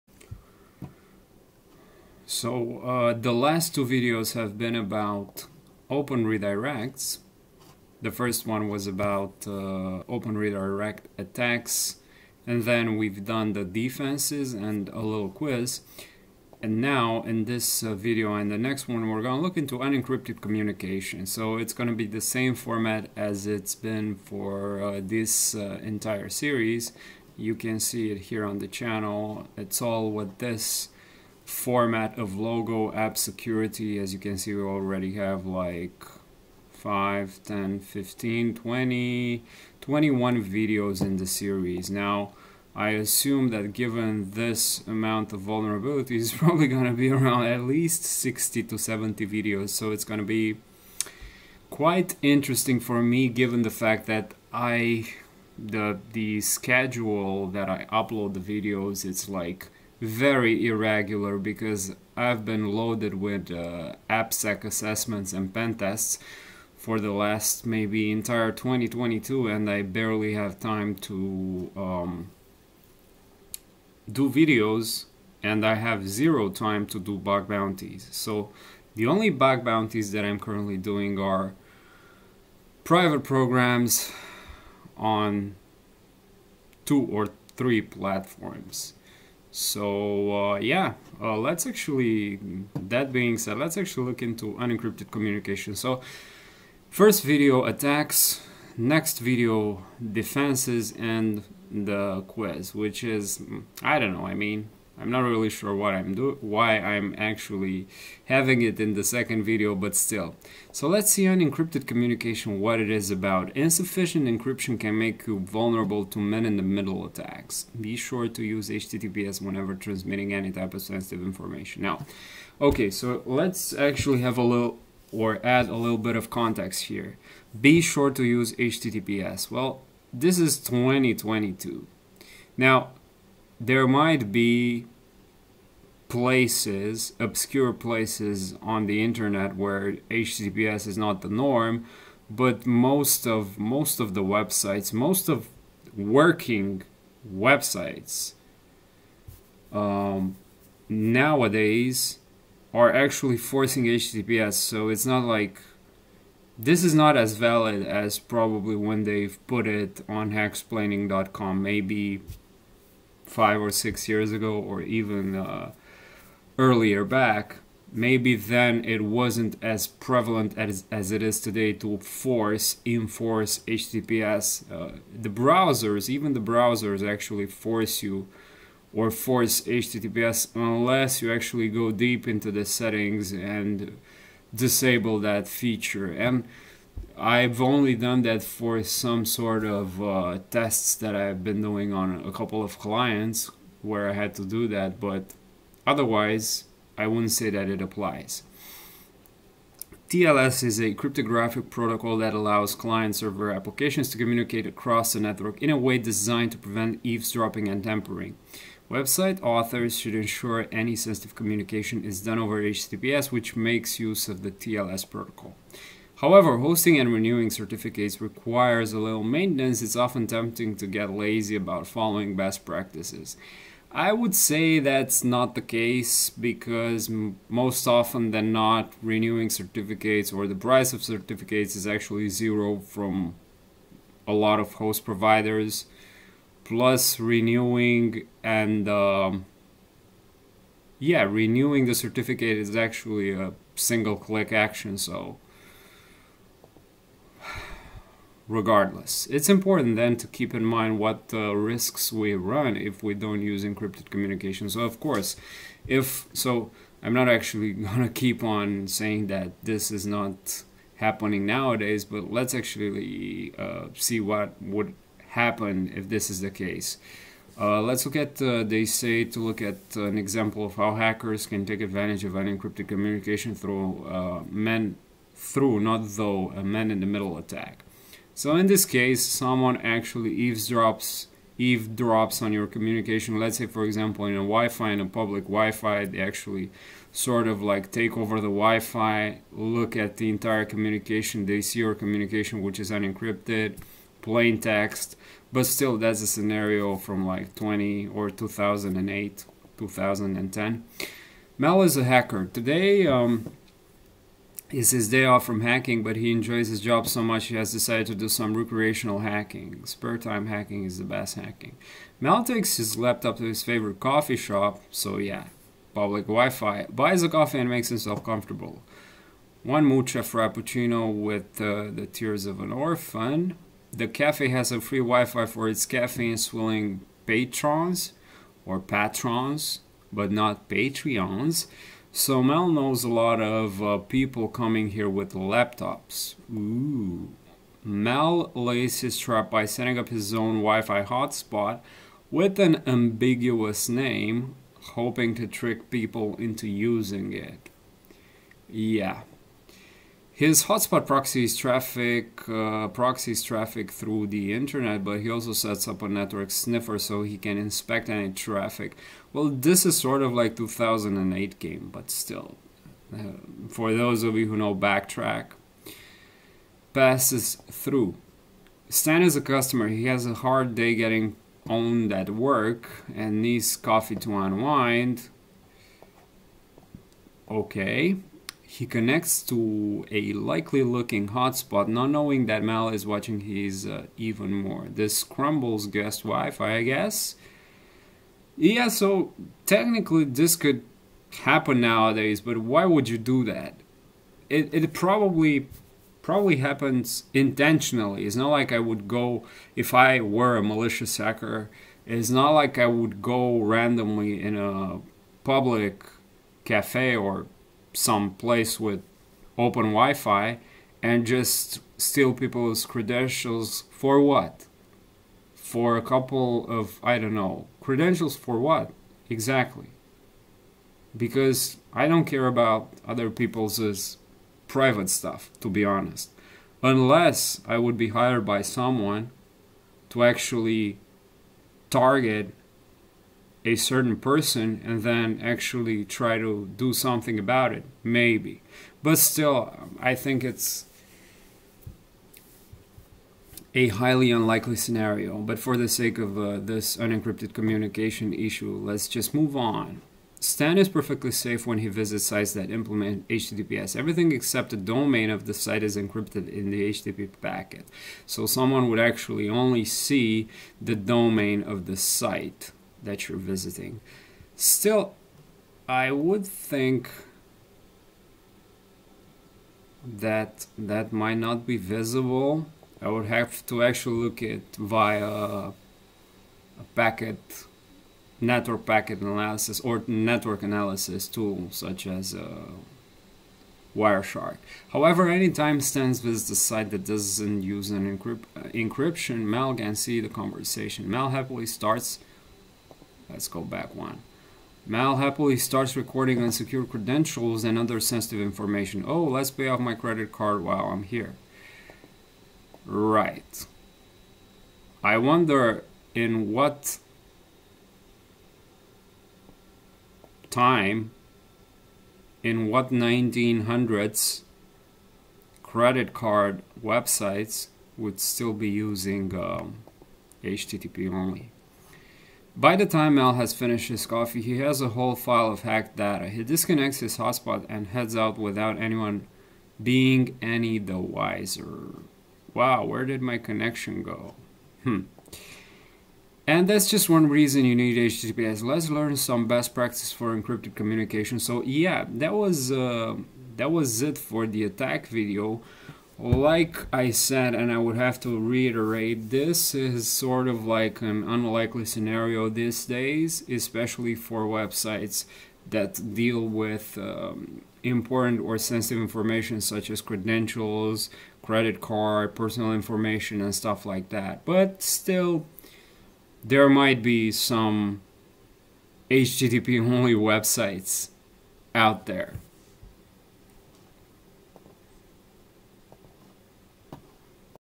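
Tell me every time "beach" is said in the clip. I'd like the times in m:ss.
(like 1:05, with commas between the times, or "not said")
not said.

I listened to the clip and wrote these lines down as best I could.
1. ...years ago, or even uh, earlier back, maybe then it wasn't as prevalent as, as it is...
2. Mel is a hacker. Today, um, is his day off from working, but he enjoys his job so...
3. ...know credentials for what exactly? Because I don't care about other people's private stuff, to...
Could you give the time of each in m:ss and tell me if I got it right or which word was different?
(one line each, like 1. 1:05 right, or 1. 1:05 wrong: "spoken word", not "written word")
1. 2:44 right
2. 5:01 wrong: "hacking", not "working"
3. 6:57 right.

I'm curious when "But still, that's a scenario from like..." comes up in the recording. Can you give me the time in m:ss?
4:55.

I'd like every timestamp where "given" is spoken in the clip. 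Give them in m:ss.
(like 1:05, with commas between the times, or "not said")
0:43, 0:53.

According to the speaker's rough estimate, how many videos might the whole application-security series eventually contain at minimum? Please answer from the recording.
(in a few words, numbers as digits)
60.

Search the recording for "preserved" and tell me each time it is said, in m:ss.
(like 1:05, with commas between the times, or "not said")
not said.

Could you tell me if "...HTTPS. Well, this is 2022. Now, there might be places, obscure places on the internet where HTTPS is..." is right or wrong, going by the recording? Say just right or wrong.
right.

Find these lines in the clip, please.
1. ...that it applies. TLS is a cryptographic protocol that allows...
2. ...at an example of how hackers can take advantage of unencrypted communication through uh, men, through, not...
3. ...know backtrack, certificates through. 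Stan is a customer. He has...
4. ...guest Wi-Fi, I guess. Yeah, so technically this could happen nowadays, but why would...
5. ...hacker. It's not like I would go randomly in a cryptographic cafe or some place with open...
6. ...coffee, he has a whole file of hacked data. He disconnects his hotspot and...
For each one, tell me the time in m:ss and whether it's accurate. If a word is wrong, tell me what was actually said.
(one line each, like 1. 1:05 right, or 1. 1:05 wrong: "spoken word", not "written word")
1. 3:17 right
2. 4:29 right
3. 6:04 wrong: "passes", not "certificates"
4. 6:25 right
5. 6:41 wrong: "public", not "cryptographic"
6. 8:44 right.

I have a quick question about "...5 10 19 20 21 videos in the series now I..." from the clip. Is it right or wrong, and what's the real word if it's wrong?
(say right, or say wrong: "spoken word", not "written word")
wrong: "15", not "19".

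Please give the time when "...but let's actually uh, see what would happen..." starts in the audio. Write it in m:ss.
4:22.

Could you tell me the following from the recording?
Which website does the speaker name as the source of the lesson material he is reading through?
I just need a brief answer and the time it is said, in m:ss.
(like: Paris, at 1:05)
hacksplaining.com, at 2:40.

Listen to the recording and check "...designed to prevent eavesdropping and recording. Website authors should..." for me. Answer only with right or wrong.
wrong.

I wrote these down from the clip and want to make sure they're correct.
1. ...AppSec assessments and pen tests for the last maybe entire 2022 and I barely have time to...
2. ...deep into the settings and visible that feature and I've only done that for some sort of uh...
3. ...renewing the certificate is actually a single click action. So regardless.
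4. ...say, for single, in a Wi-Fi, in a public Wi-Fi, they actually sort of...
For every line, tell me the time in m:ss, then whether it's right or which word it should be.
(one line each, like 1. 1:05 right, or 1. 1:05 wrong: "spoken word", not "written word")
1. 1:04 right
2. 3:01 wrong: "disable", not "visible"
3. 4:01 right
4. 4:43 wrong: "example", not "single".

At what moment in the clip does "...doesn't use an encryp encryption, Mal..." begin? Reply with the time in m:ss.
8:07.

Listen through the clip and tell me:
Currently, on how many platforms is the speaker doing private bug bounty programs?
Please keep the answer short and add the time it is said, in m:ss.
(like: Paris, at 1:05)
two or three, at 1:26.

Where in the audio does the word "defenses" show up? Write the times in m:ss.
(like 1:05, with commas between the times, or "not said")
0:13, 1:40.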